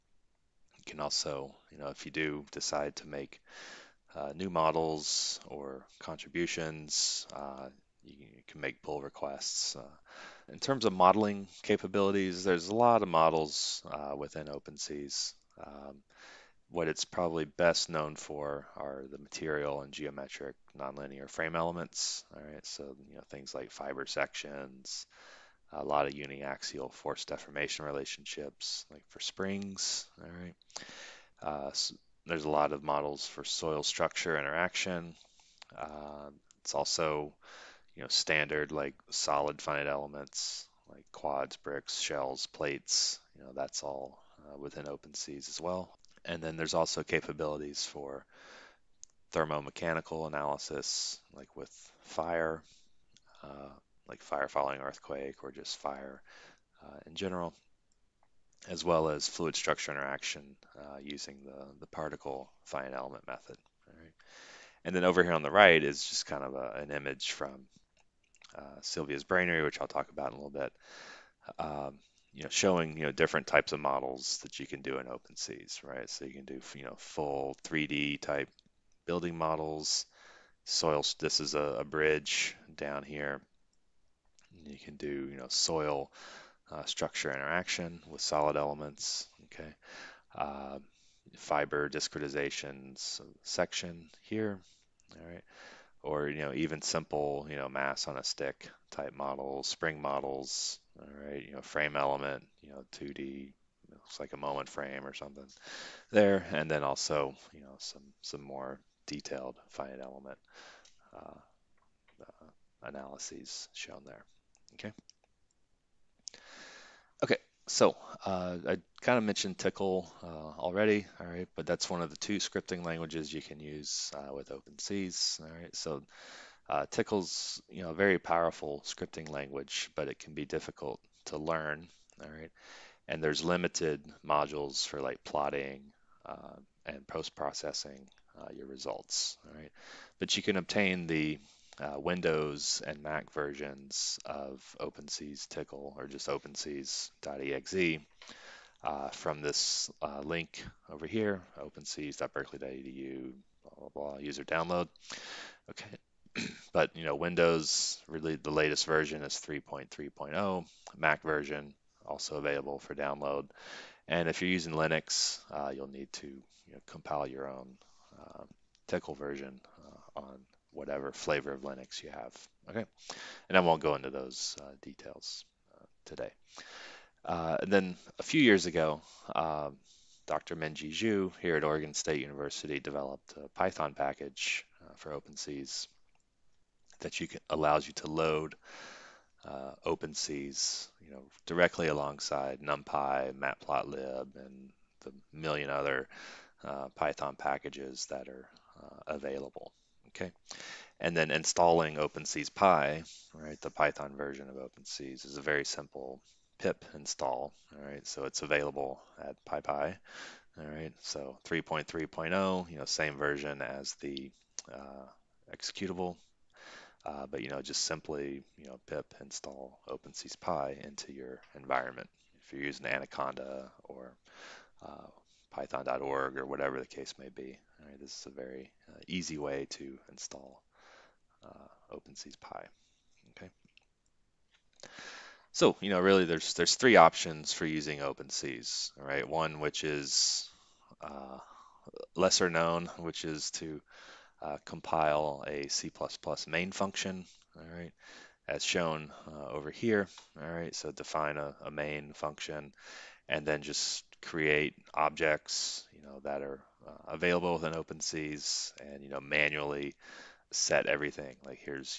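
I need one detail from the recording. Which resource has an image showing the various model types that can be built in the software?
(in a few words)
Silvia's Brainery.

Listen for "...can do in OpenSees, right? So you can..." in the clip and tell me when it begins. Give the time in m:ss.
1:14.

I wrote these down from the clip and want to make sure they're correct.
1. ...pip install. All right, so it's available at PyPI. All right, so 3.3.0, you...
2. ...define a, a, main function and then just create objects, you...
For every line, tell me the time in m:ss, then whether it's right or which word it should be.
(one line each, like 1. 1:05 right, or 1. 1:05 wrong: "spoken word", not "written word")
1. 3:26 right
2. 4:10 right.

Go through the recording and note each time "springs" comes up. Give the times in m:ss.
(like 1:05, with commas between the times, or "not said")
0:29, 1:39.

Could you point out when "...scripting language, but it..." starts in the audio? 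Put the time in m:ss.
2:08.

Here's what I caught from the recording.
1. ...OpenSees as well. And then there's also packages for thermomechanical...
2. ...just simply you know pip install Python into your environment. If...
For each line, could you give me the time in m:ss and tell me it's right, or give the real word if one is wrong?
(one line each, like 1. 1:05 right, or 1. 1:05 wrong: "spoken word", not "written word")
1. 0:44 wrong: "capabilities", not "packages"
2. 3:37 wrong: "OpenSeesPy", not "Python".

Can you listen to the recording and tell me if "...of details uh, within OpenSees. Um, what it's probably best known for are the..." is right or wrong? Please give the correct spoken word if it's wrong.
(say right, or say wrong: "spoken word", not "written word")
wrong: "models", not "details".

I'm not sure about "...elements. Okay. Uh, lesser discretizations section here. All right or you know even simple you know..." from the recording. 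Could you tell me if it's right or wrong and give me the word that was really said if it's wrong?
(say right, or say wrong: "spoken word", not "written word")
wrong: "fiber", not "lesser".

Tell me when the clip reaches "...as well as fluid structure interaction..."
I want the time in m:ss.
0:58.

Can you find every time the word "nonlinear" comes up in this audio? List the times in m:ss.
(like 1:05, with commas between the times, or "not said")
0:20.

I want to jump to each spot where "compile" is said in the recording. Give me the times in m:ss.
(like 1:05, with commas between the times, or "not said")
2:46, 4:04.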